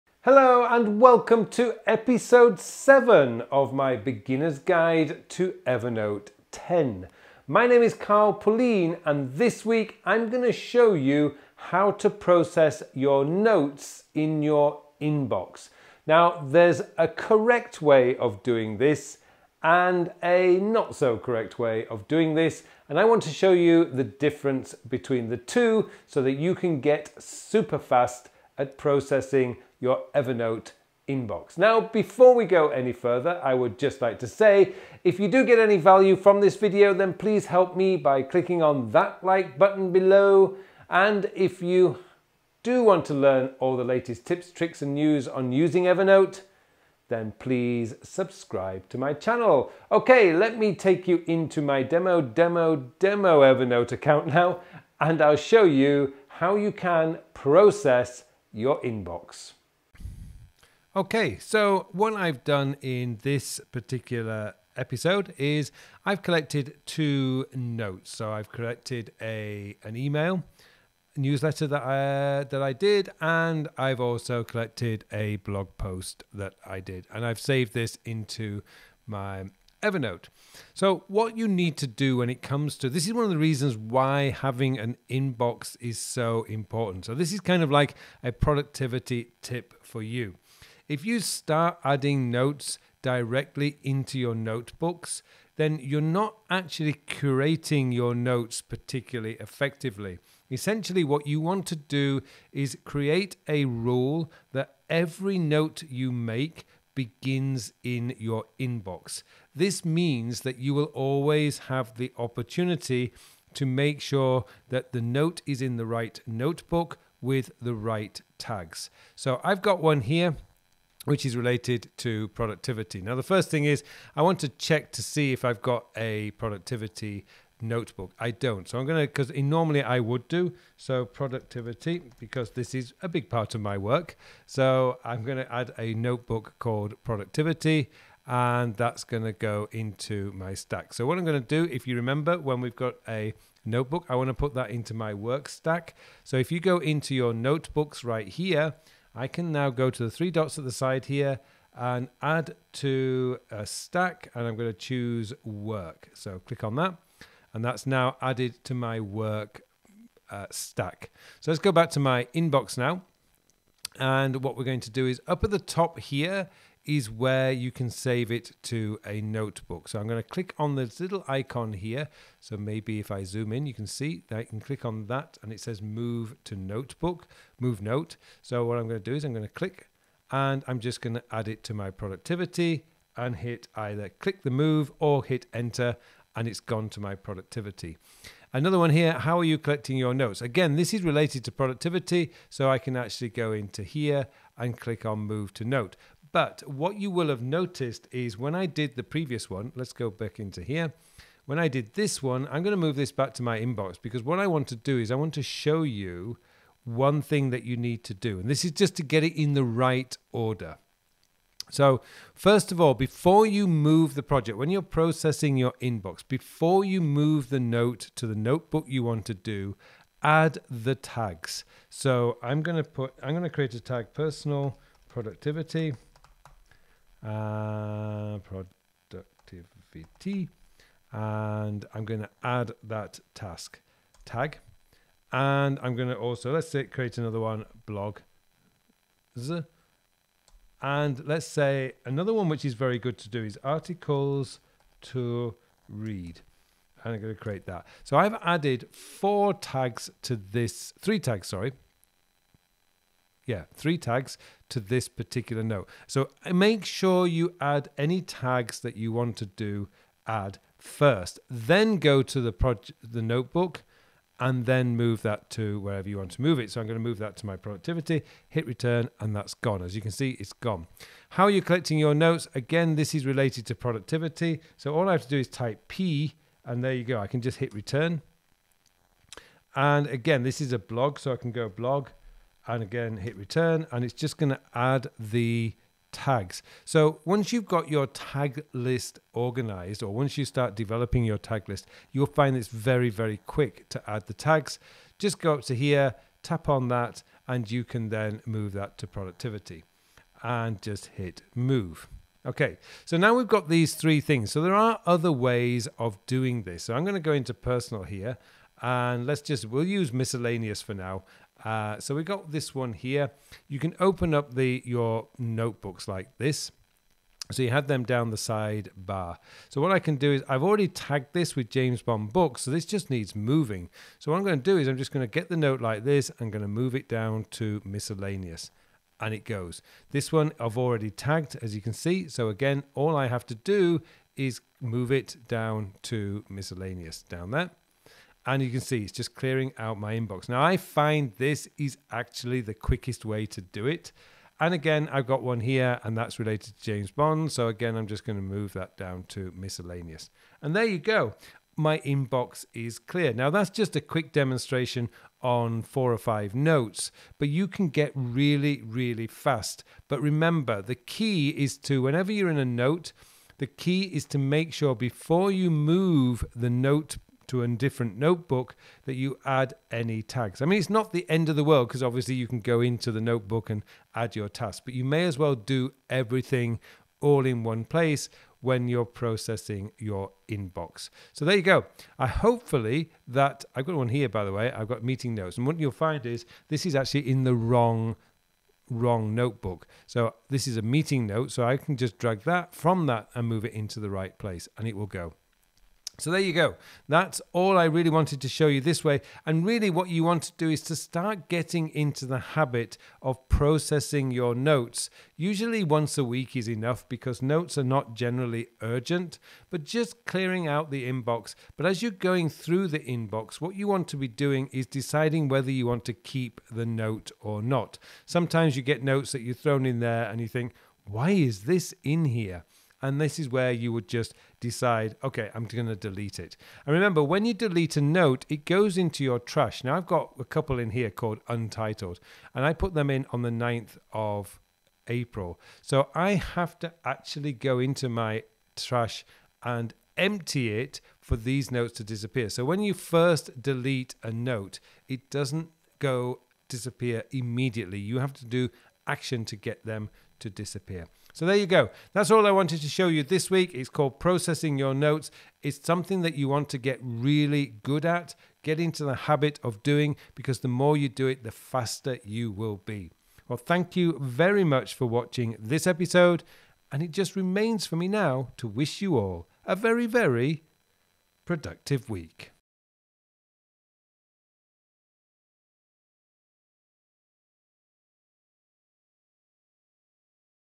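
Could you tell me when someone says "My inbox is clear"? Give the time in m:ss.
5:51.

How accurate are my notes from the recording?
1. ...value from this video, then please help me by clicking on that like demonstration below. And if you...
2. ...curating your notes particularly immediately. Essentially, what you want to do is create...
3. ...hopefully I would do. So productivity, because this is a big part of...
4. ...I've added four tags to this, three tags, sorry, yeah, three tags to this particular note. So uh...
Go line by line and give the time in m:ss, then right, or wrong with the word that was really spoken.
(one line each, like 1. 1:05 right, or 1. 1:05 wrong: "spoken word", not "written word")
1. 0:35 wrong: "button", not "demonstration"
2. 1:37 wrong: "effectively", not "immediately"
3. 2:09 wrong: "normally", not "hopefully"
4. 4:08 right.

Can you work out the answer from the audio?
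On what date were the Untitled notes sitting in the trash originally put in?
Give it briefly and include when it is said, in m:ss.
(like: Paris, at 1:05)
9th of April, at 7:13.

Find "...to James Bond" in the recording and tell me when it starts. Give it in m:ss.
5:46.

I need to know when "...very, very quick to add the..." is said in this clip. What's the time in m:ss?
4:52.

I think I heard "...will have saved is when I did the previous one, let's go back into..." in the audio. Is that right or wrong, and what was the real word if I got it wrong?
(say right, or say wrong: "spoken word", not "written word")
wrong: "noticed", not "saved".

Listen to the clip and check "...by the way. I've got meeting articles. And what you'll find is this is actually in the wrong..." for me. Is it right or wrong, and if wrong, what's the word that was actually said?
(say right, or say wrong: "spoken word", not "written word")
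wrong: "notes", not "articles".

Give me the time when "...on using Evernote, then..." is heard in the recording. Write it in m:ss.
0:45.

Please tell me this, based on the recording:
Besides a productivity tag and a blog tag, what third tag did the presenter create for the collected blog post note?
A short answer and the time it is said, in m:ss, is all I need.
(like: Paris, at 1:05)
articles to read, at 4:03.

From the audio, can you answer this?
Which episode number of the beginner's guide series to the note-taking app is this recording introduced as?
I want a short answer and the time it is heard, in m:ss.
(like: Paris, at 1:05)
7, at 0:01.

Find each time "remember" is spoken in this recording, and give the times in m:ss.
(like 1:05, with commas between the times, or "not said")
2:21, 6:00, 7:06.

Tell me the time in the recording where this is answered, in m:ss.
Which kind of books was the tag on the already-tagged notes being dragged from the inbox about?
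5:21.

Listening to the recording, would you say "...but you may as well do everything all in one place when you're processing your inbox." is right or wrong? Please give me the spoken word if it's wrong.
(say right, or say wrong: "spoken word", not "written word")
right.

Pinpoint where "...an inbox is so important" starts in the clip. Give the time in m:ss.
1:24.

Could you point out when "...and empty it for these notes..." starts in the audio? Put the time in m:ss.
7:19.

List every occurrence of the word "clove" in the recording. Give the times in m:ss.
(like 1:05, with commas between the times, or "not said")
not said.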